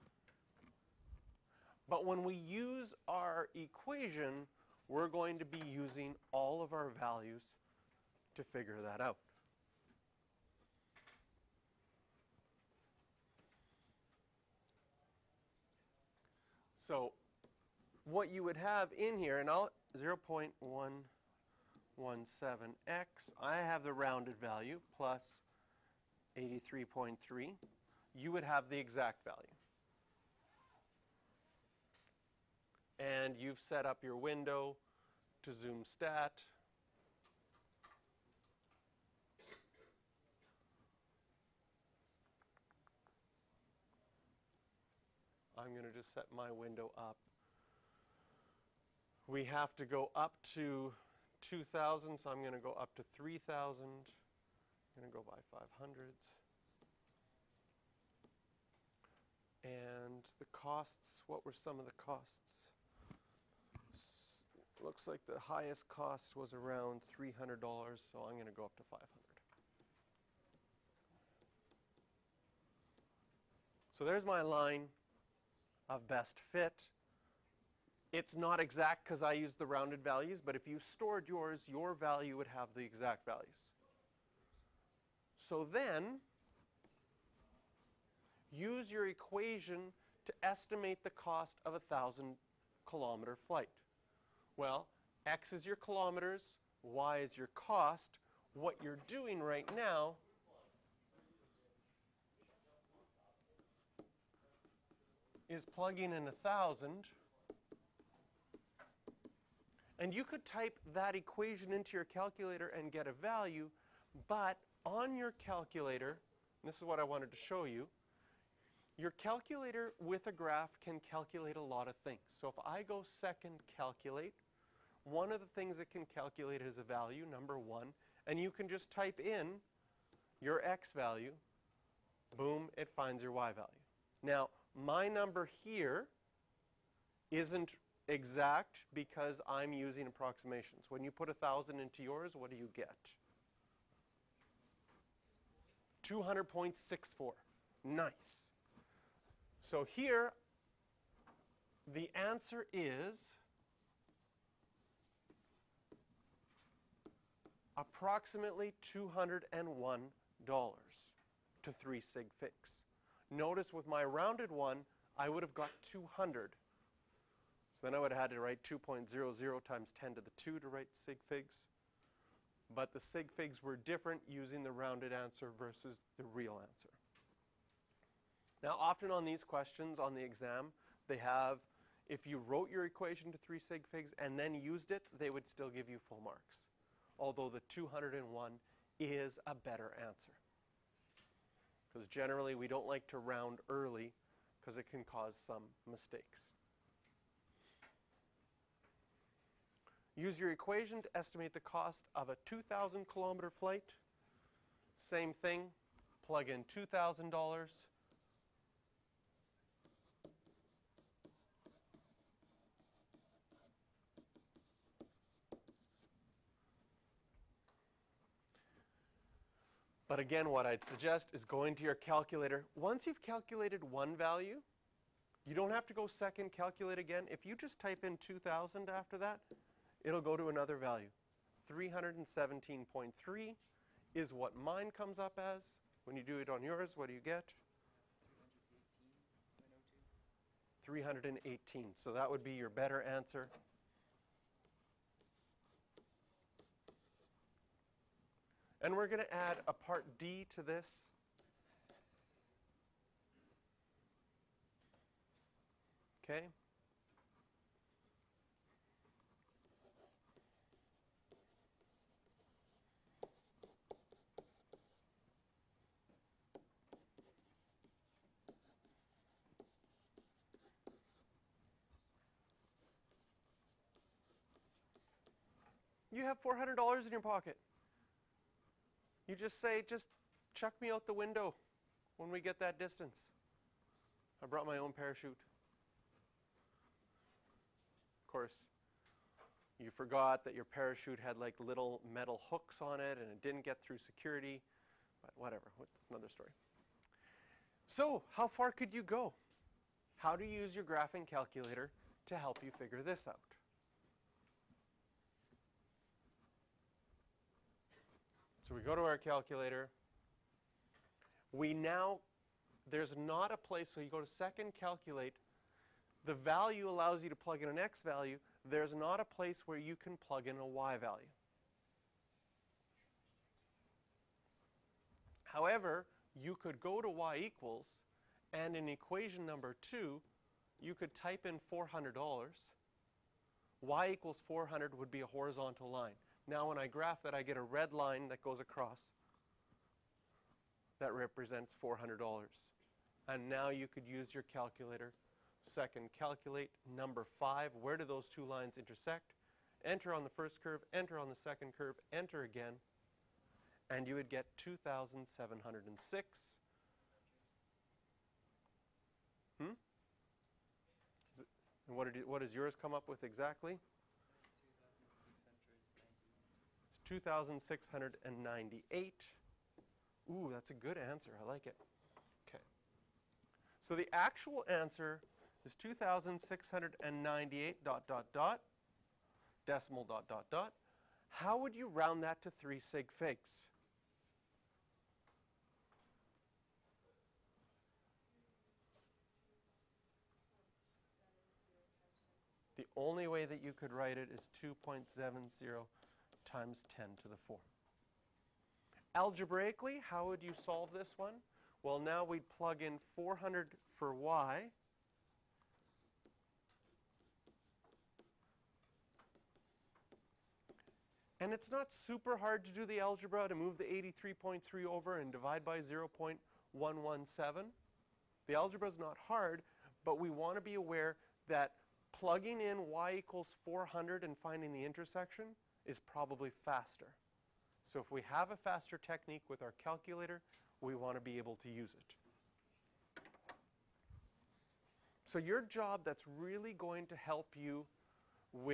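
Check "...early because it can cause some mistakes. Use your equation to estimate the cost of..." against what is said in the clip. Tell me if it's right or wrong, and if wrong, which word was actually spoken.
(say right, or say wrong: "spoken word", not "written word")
right.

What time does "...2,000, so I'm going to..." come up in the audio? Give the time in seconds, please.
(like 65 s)
51 s.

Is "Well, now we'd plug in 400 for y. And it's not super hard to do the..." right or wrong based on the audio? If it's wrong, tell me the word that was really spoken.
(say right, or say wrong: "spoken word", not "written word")
right.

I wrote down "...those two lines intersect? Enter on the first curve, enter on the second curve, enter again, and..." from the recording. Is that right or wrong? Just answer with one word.
right.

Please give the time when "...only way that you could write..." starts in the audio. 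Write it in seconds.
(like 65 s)
392 s.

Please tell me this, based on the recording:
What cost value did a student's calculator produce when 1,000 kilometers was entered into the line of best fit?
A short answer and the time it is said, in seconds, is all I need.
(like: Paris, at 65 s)
200.64, at 146 s.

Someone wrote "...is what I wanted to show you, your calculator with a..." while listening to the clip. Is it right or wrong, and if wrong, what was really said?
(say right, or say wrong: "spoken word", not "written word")
right.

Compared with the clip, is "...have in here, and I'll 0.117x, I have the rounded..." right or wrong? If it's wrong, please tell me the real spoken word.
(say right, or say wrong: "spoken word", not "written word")
right.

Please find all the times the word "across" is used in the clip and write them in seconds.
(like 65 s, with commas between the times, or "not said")
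338 s.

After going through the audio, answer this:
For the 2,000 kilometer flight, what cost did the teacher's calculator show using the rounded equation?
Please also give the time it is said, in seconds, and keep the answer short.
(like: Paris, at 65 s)
317.3, at 231 s.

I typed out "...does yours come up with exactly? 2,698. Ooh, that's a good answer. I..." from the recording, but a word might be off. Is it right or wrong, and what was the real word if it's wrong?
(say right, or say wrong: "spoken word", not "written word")
right.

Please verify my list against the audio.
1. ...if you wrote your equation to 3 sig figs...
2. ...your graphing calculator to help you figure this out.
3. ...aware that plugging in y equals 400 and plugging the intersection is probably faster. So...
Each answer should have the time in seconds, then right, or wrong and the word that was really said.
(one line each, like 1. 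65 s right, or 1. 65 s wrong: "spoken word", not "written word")
1. 182 s right
2. 300 s right
3. 420 s wrong: "finding", not "plugging".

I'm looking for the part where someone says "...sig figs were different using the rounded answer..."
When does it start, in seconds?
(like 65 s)
172 s.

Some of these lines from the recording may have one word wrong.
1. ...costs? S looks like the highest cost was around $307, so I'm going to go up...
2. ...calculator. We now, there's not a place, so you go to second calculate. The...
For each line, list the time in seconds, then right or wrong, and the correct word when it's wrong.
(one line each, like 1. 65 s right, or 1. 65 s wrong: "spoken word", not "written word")
1. 61 s wrong: "300", not "307"
2. 309 s right.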